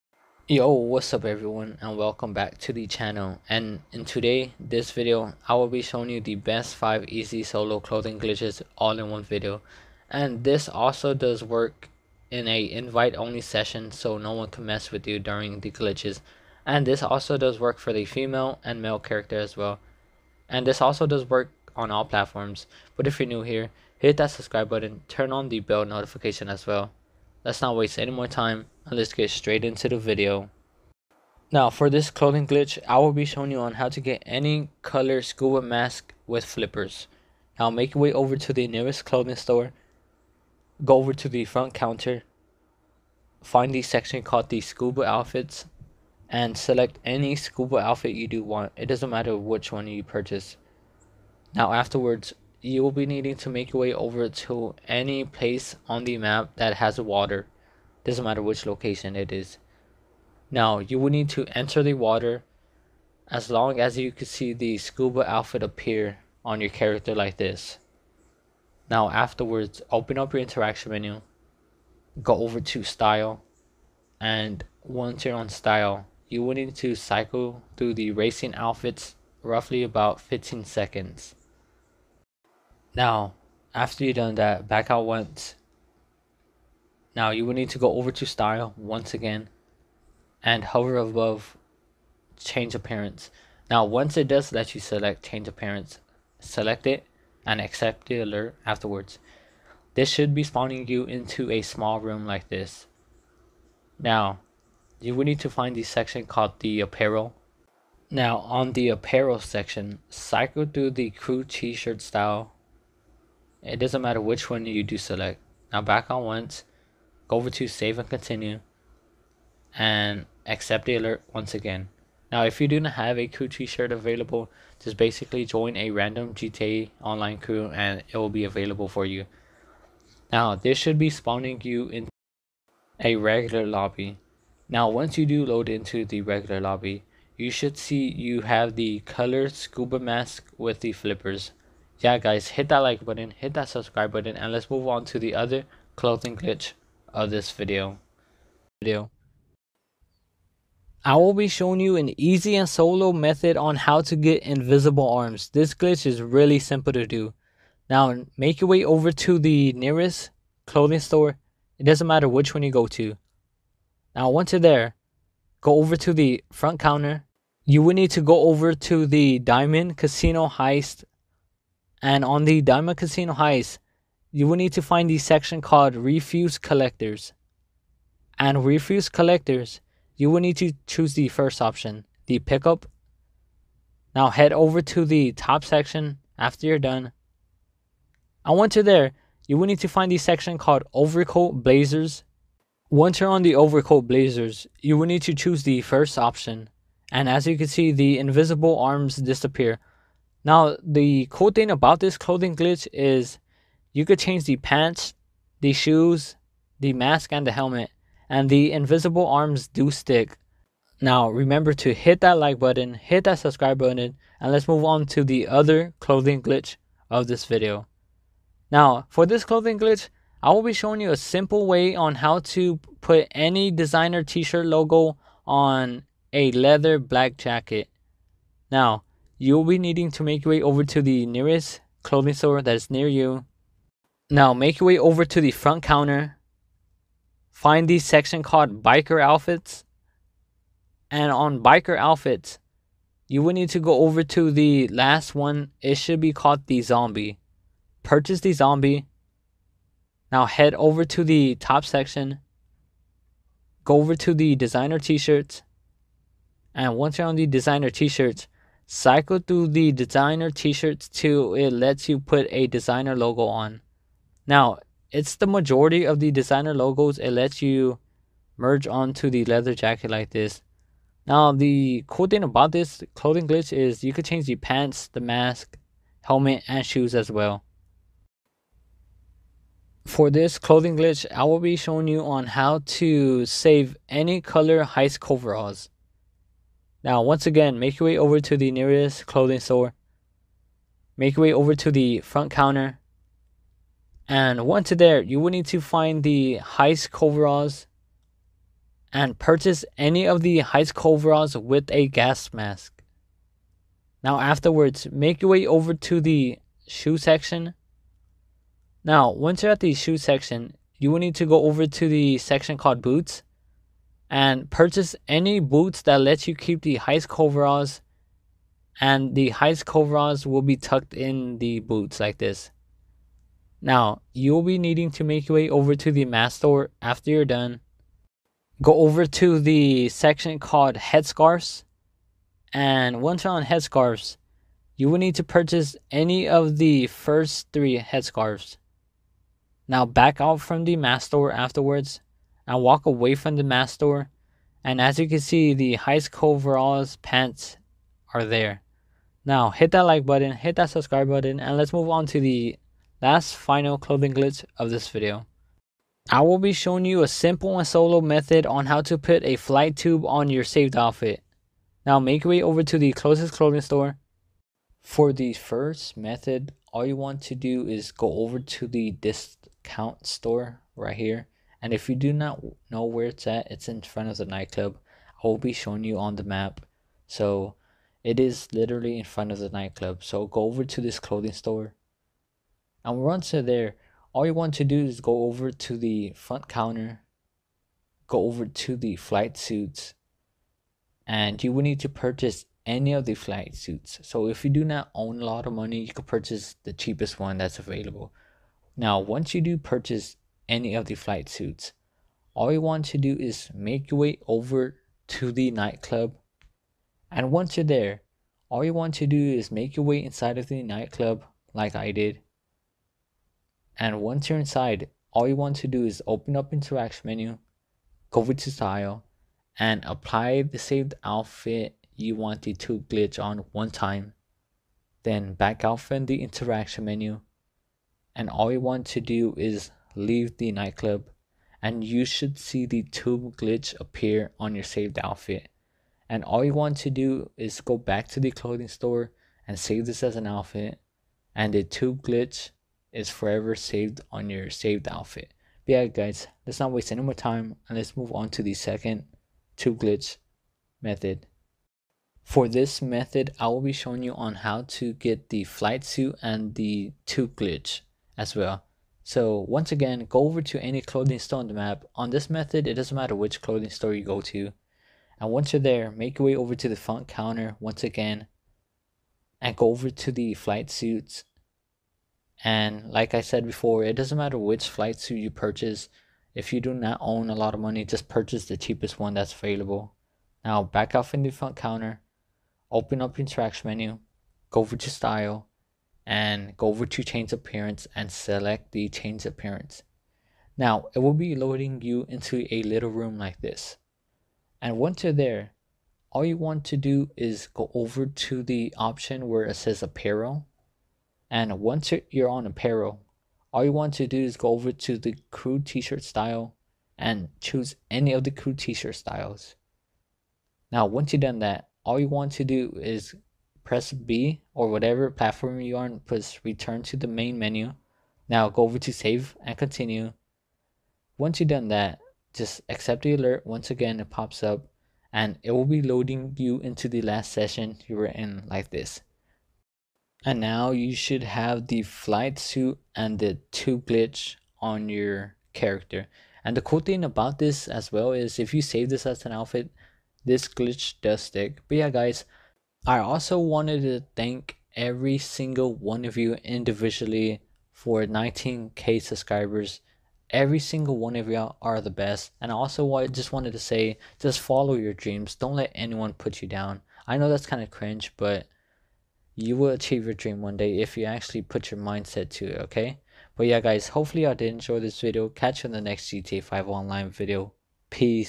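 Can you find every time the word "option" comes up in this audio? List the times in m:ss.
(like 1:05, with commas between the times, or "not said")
3:01, 3:16, 8:18.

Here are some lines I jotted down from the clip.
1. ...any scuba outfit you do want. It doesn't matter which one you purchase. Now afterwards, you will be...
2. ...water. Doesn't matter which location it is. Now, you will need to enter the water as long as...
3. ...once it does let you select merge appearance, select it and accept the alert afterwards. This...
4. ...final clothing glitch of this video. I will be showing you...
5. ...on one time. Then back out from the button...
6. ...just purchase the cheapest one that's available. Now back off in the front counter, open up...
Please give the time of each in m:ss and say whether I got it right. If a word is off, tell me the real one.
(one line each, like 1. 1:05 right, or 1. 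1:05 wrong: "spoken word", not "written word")
1. 0:47 right
2. 0:57 right
3. 1:33 wrong: "change", not "merge"
4. 5:53 right
5. 7:03 wrong: "interaction", not "button"
6. 7:58 right.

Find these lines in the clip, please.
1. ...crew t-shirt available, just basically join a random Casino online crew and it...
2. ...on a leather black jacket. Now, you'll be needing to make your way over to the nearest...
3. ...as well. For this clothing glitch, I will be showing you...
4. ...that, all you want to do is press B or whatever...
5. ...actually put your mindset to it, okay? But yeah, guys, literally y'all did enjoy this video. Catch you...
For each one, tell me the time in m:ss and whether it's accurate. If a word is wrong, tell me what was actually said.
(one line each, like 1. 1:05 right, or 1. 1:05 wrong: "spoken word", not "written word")
1. 2:03 wrong: "GTA", not "Casino"
2. 3:45 right
3. 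4:37 right
4. 8:31 right
5. 9:21 wrong: "hopefully", not "literally".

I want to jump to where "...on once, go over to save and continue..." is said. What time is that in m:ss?
1:56.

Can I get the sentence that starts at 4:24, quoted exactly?
Now, it's the majority of the designer logos it lets you merge onto the leather jacket like this.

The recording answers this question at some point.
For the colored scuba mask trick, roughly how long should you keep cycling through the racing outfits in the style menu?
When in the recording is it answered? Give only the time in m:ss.
1:20.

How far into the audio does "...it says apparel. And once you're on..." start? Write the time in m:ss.
8:19.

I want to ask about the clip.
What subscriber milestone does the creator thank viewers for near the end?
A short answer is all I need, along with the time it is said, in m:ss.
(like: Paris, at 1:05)
19k, at 9:08.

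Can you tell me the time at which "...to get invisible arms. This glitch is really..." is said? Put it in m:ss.
2:34.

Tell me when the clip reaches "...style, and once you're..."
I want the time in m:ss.
1:12.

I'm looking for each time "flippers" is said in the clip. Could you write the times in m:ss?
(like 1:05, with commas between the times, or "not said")
0:36, 2:20.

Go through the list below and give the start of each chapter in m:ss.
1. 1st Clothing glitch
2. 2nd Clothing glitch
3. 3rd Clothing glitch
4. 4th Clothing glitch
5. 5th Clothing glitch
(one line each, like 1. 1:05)
1. 0:31
2. 2:29
3. 3:37
4. 4:40
5. 5:56.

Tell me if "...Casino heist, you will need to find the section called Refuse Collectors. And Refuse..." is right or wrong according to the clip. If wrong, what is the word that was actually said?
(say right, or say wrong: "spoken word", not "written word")
right.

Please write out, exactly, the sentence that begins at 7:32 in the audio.
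For this method, I will be showing you on how to get the flight suit and the tube glitch as well.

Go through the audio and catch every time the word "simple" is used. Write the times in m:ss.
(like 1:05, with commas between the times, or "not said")
2:36, 3:41, 5:57.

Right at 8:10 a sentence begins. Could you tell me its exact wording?
Now it will be loading you into a little room like this.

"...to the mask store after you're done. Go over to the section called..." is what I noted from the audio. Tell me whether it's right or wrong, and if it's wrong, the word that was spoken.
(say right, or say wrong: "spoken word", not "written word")
right.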